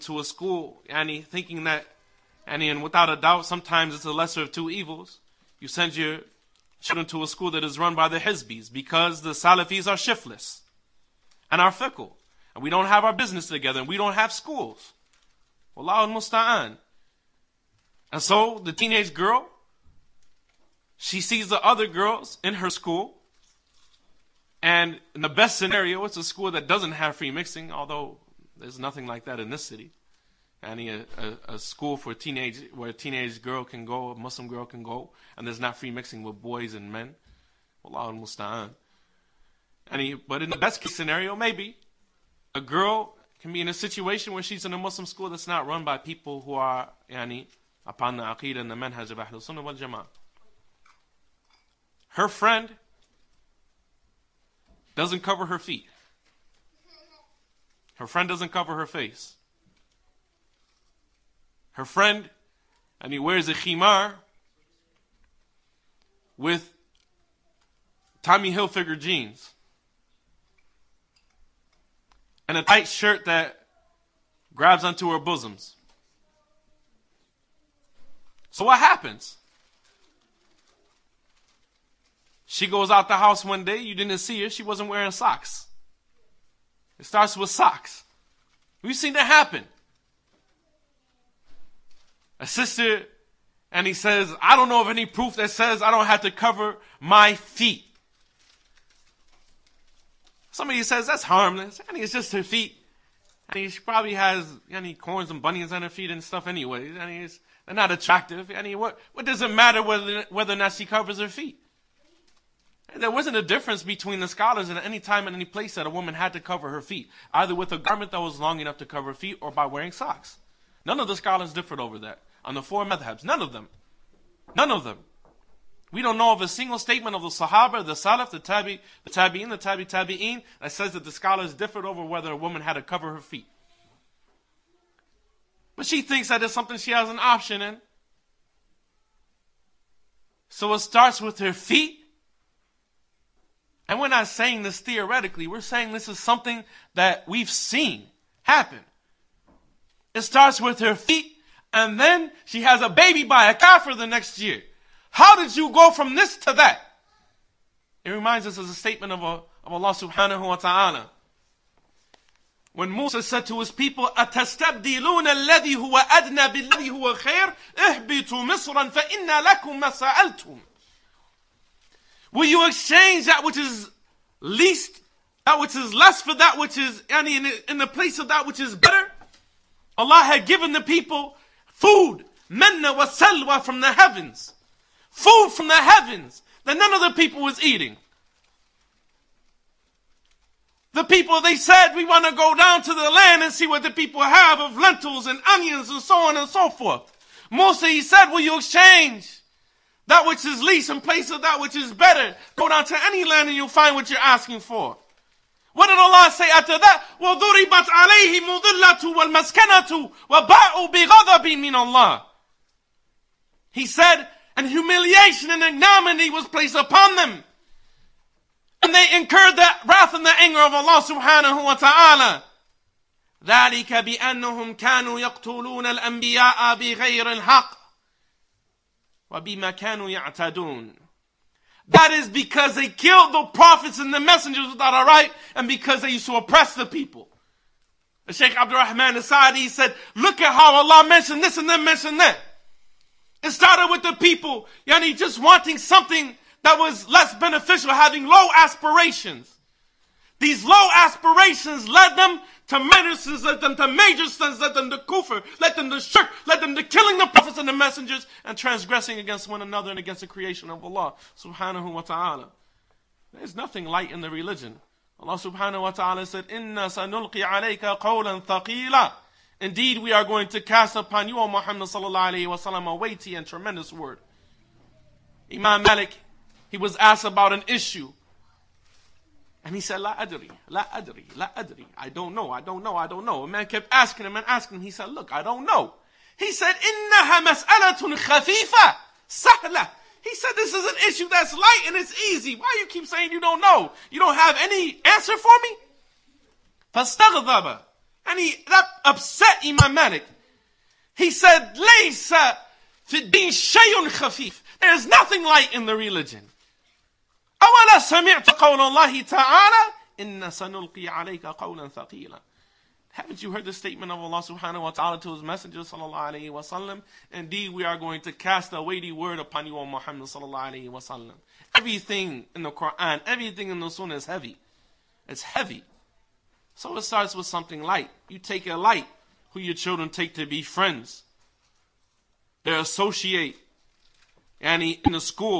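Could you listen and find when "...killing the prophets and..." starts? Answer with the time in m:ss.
4:16.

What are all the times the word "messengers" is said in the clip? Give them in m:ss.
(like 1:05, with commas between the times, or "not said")
3:54, 4:17, 5:15.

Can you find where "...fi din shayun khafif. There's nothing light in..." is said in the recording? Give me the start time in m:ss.
5:03.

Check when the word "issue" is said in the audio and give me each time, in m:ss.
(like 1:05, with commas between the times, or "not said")
4:37, 4:51.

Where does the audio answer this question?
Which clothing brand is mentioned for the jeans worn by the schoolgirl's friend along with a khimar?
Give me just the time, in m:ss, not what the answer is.
1:08.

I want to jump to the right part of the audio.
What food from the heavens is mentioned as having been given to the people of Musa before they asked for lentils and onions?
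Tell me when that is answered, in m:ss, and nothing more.
3:02.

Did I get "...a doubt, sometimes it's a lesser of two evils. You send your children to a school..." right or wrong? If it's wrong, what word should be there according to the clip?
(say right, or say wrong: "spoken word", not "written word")
right.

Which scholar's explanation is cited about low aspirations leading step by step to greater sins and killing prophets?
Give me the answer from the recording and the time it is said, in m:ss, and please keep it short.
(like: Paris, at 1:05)
Abdurrahman as-Sa'di, at 3:58.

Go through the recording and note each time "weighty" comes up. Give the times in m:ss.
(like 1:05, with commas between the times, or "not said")
4:32, 5:18.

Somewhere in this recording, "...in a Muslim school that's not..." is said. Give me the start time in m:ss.
0:44.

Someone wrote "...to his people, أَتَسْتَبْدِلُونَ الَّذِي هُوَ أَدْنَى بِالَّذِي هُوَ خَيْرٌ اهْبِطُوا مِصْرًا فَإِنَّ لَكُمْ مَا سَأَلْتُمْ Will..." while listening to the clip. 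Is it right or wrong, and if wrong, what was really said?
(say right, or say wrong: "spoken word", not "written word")
right.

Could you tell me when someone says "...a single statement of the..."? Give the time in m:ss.
2:06.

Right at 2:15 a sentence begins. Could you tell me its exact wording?
But she thinks that it's something she has an option in.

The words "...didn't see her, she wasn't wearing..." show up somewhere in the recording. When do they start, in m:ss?
1:23.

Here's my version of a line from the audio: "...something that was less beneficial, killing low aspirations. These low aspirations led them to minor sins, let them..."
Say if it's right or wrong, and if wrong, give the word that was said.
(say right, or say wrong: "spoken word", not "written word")
wrong: "having", not "killing".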